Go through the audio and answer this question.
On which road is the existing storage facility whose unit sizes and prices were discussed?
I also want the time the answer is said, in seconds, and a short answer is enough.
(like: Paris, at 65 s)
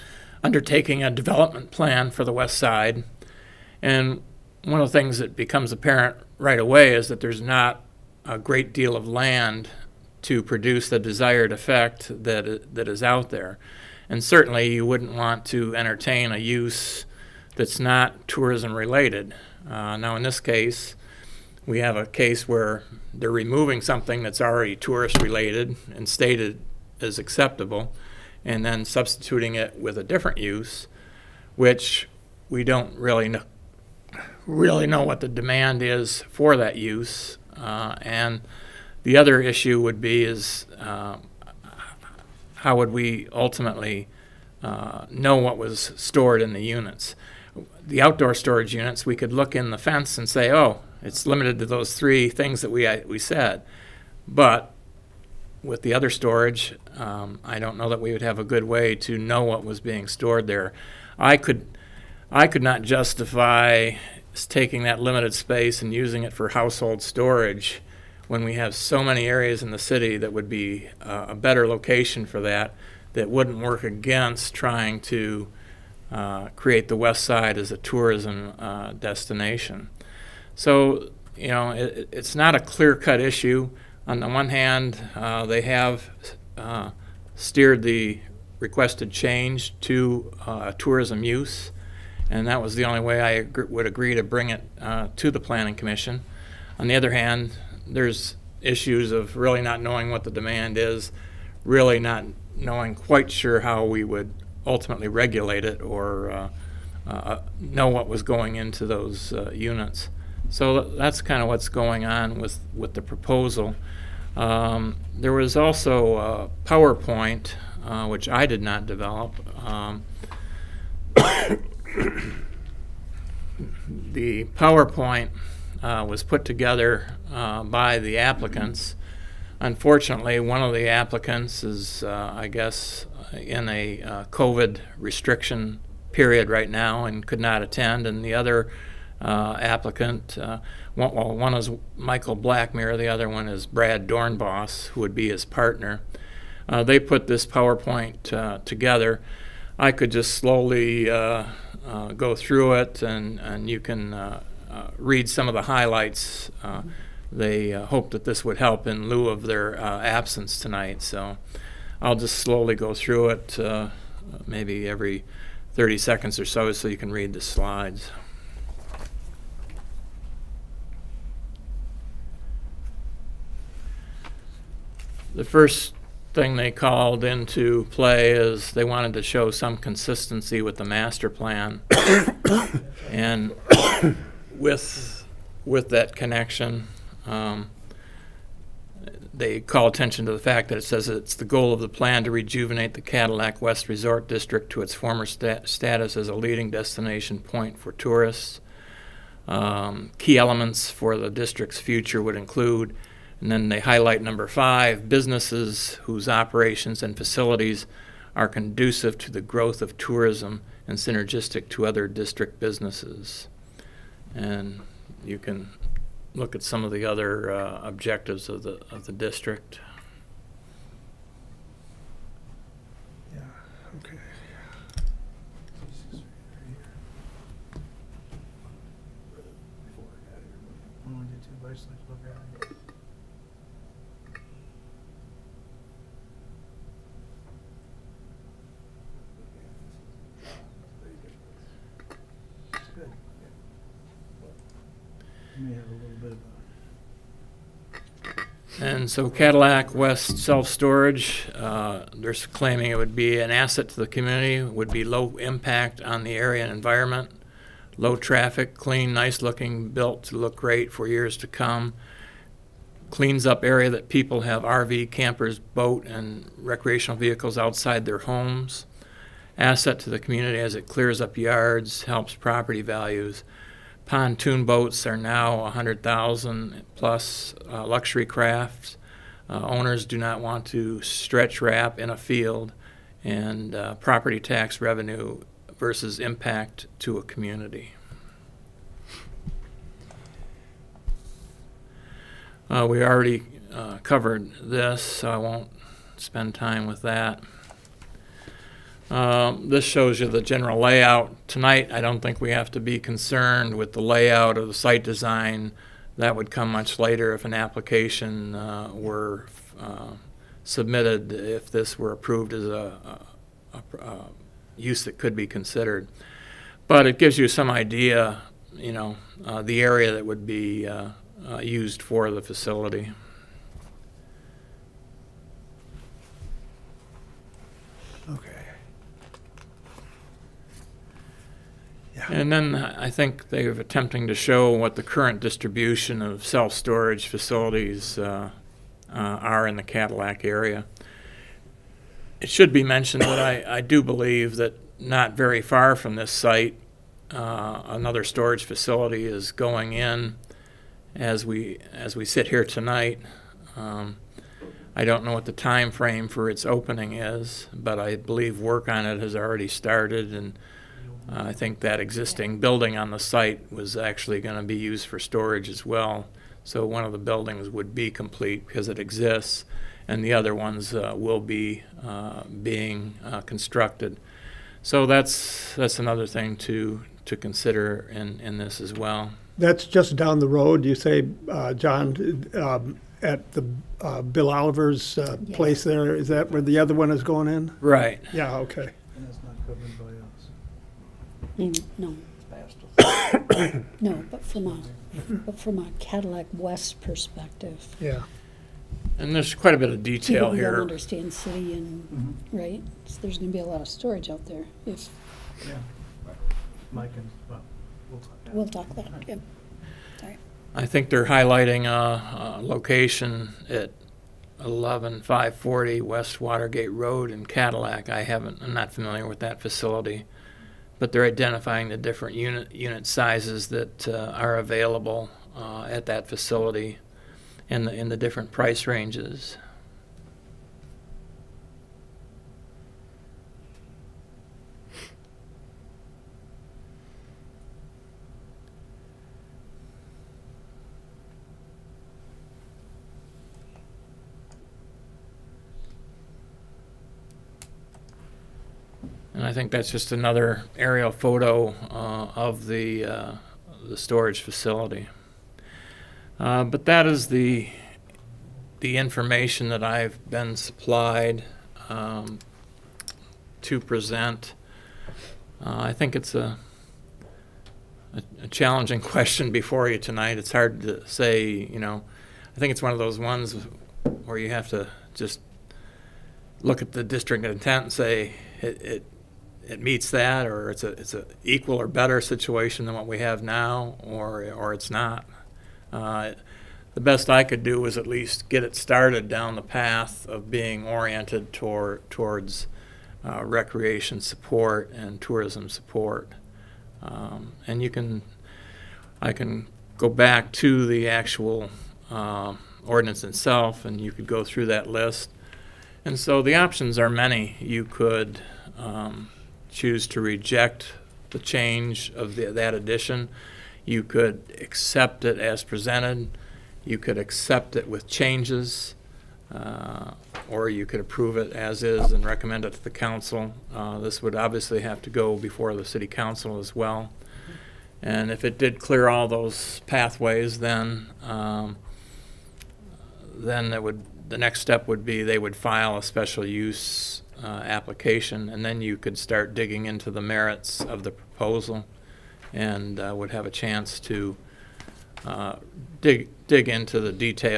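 West Watergate Road, at 415 s.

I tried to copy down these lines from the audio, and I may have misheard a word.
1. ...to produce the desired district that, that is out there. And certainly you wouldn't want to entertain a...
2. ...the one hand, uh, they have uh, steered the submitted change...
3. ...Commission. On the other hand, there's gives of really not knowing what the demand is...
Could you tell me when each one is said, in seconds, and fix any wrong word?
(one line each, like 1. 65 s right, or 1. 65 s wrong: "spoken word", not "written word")
1. 10 s wrong: "effect", not "district"
2. 84 s wrong: "requested", not "submitted"
3. 95 s wrong: "issues", not "gives".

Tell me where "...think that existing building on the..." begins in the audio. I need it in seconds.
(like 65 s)
361 s.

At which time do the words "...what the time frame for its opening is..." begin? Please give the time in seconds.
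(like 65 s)
355 s.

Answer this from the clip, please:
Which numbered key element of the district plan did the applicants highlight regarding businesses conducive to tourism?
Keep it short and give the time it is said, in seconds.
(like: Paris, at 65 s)
5, at 204 s.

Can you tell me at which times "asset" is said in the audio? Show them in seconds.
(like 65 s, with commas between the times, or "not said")
253 s, 269 s.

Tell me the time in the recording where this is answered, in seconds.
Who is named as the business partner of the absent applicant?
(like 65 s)
143 s.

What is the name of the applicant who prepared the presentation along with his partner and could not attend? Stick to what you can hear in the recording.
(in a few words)
Michael Blackmere.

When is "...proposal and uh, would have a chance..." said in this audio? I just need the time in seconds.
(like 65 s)
541 s.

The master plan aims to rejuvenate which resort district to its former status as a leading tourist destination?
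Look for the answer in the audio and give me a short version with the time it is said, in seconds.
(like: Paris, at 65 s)
Cadillac West Resort District, at 192 s.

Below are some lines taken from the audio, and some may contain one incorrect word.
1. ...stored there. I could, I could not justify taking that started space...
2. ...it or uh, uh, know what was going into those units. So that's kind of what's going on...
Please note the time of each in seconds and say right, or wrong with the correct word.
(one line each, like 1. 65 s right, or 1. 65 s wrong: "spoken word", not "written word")
1. 60 s wrong: "limited", not "started"
2. 105 s right.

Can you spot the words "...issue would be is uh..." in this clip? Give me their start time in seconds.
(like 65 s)
39 s.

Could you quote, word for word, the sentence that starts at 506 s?
And so the options are many.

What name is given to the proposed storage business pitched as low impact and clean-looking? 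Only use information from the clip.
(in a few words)
Cadillac West Self Storage.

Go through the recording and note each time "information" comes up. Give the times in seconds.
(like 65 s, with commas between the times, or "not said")
458 s.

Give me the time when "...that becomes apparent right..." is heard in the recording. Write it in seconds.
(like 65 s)
5 s.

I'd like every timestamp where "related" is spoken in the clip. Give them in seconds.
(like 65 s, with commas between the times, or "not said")
18 s, 25 s.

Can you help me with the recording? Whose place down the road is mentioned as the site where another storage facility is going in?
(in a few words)
Bill Oliver's.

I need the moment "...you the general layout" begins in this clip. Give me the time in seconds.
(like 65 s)
300 s.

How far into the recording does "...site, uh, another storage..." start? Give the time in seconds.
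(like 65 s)
346 s.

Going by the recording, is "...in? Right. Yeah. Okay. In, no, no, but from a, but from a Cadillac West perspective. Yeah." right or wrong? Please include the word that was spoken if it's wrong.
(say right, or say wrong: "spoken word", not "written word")
right.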